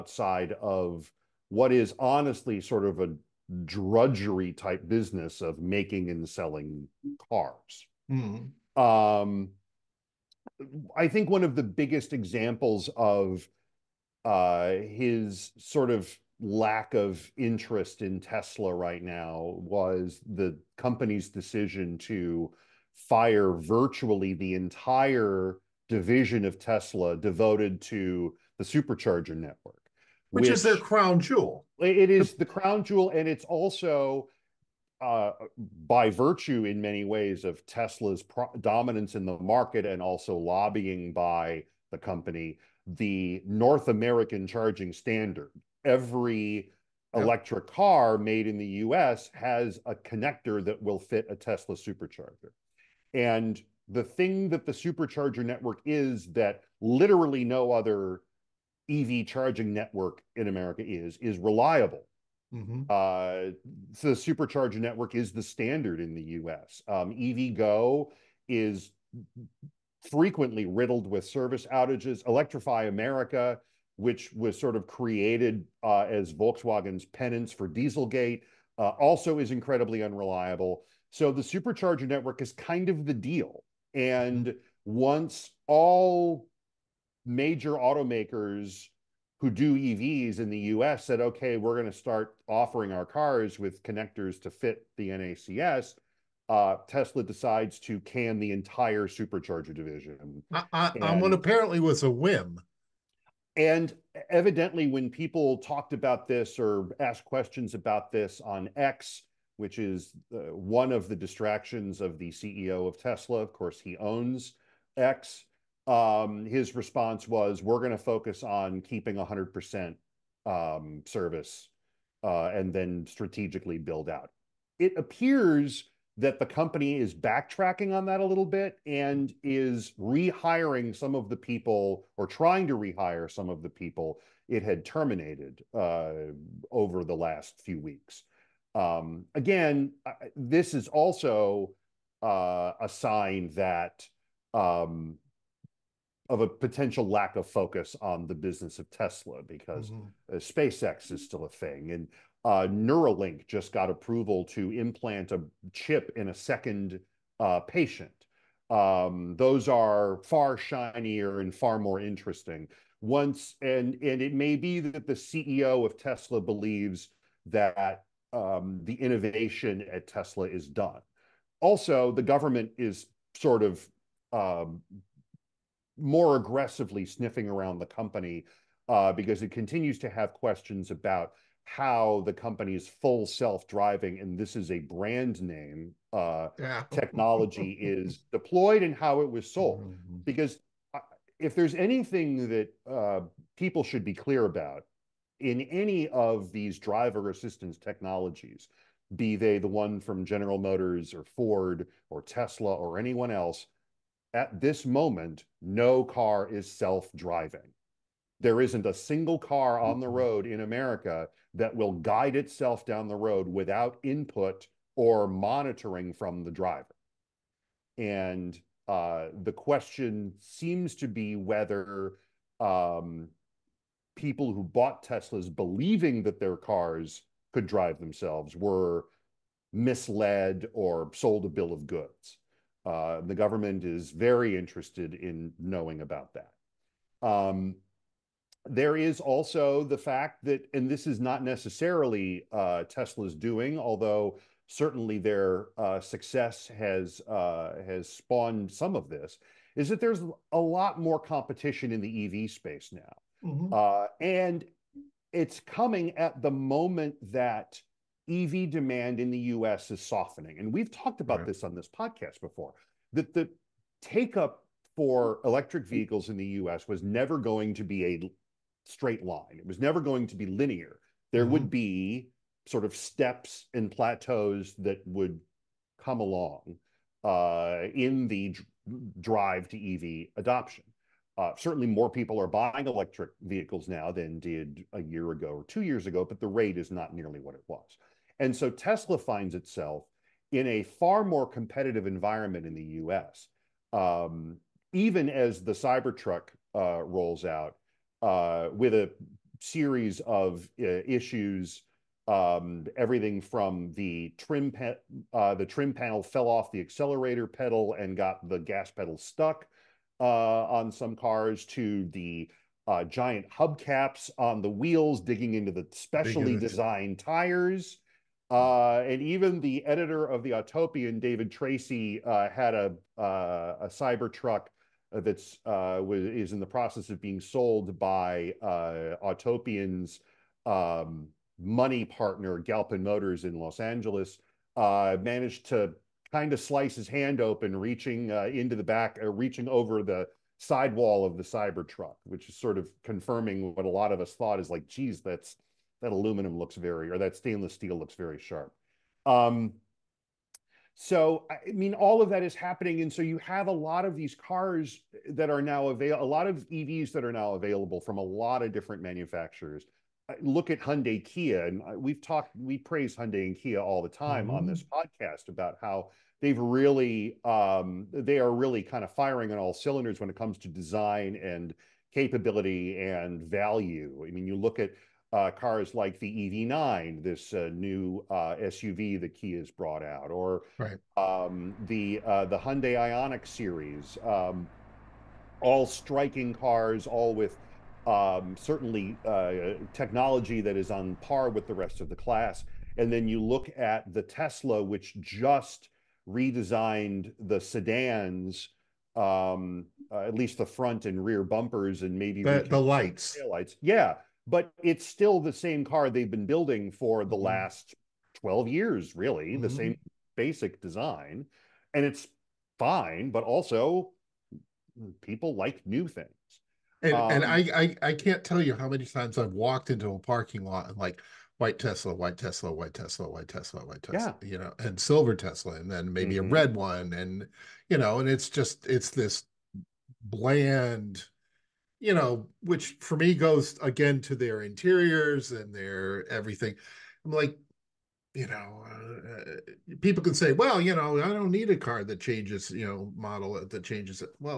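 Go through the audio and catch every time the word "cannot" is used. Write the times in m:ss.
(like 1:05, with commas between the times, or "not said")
not said.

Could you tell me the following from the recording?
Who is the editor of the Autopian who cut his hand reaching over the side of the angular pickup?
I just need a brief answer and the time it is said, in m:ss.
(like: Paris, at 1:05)
David Tracy, at 5:21.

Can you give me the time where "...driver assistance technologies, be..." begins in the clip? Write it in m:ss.
3:16.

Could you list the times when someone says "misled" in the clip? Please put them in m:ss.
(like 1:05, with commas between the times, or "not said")
3:49.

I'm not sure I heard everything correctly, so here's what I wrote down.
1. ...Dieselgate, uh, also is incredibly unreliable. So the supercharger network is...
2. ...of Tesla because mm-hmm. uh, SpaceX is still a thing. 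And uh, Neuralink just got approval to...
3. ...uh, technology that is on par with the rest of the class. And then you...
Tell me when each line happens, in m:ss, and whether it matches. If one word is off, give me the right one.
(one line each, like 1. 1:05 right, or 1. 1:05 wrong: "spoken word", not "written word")
1. 1:17 right
2. 2:28 right
3. 6:29 right.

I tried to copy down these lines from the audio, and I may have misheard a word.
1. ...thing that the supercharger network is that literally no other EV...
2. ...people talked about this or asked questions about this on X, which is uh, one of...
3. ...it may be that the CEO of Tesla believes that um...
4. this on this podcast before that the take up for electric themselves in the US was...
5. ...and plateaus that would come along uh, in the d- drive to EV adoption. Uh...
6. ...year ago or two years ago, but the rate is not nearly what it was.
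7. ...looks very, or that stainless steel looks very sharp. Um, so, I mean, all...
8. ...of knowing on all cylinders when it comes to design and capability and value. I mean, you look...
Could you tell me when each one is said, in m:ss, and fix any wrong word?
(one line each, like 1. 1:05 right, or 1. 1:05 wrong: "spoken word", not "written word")
1. 0:54 right
2. 1:45 right
3. 2:44 right
4. 4:21 wrong: "vehicles", not "themselves"
5. 4:33 right
6. 4:45 right
7. 5:46 right
8. 6:09 wrong: "firing", not "knowing".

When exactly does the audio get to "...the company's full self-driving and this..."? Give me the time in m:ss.
3:02.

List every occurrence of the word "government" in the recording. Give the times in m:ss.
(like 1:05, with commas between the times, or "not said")
2:52, 3:53.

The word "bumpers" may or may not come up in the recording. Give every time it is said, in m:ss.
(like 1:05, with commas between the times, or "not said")
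6:41.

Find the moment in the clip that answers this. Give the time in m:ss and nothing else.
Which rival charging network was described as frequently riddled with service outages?
1:07.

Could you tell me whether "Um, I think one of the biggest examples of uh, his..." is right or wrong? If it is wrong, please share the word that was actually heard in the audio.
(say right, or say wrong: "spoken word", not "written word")
right.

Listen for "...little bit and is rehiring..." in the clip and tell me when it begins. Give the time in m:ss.
2:08.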